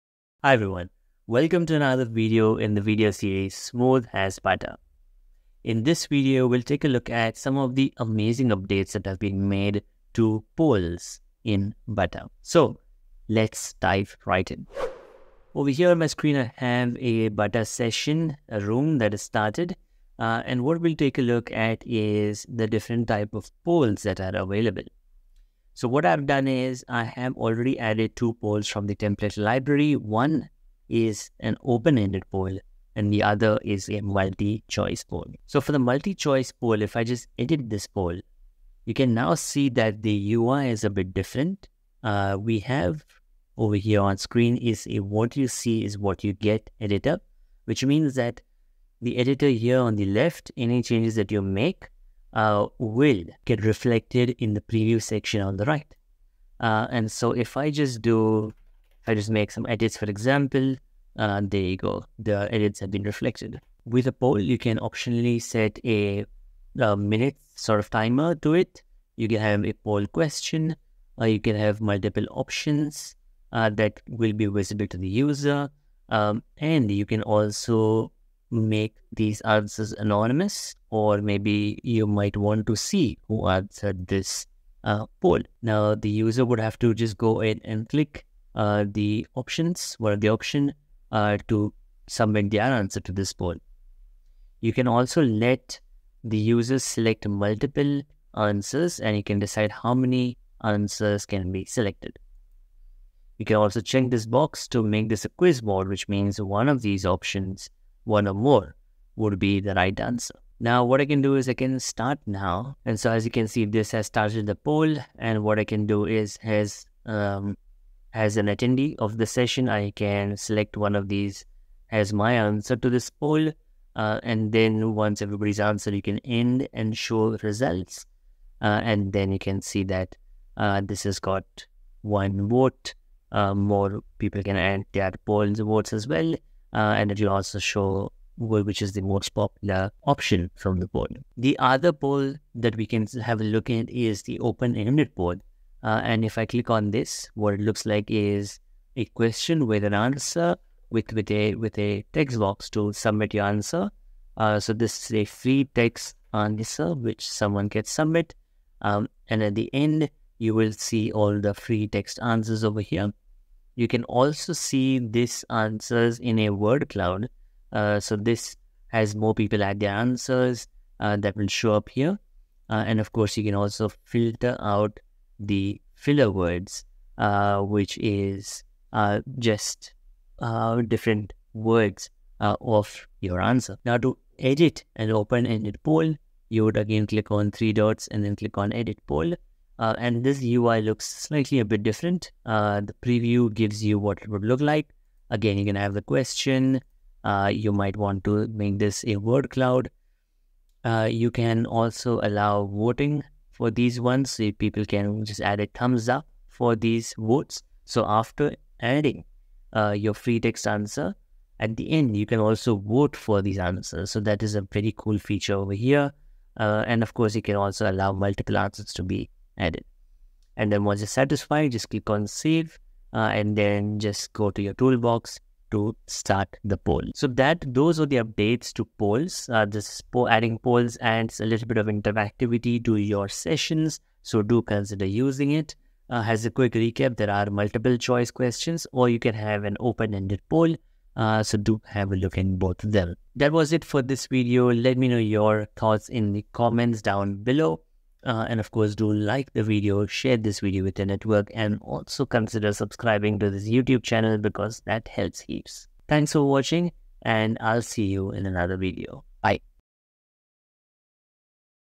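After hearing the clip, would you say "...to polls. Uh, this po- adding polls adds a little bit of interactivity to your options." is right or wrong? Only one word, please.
wrong.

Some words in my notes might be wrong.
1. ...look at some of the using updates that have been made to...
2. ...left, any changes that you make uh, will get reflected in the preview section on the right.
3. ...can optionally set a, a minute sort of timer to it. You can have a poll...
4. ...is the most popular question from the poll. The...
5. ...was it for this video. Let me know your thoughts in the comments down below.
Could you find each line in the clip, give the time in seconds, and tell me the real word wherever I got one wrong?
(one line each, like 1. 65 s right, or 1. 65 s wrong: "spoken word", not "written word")
1. 6 s wrong: "amazing", not "using"
2. 50 s right
3. 64 s right
4. 138 s wrong: "option", not "question"
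5. 243 s right.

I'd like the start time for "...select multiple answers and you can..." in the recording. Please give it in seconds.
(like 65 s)
96 s.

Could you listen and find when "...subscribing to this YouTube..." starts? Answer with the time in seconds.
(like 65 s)
252 s.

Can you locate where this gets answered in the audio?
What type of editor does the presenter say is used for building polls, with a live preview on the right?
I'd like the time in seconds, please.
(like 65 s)
44 s.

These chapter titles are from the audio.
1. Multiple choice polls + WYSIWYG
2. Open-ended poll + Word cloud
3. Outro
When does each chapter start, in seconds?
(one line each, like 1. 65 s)
1. 16 s
2. 145 s
3. 225 s.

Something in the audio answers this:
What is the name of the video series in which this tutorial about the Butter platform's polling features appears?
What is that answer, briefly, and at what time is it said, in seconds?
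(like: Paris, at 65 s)
Smooth as Butter, at 3 s.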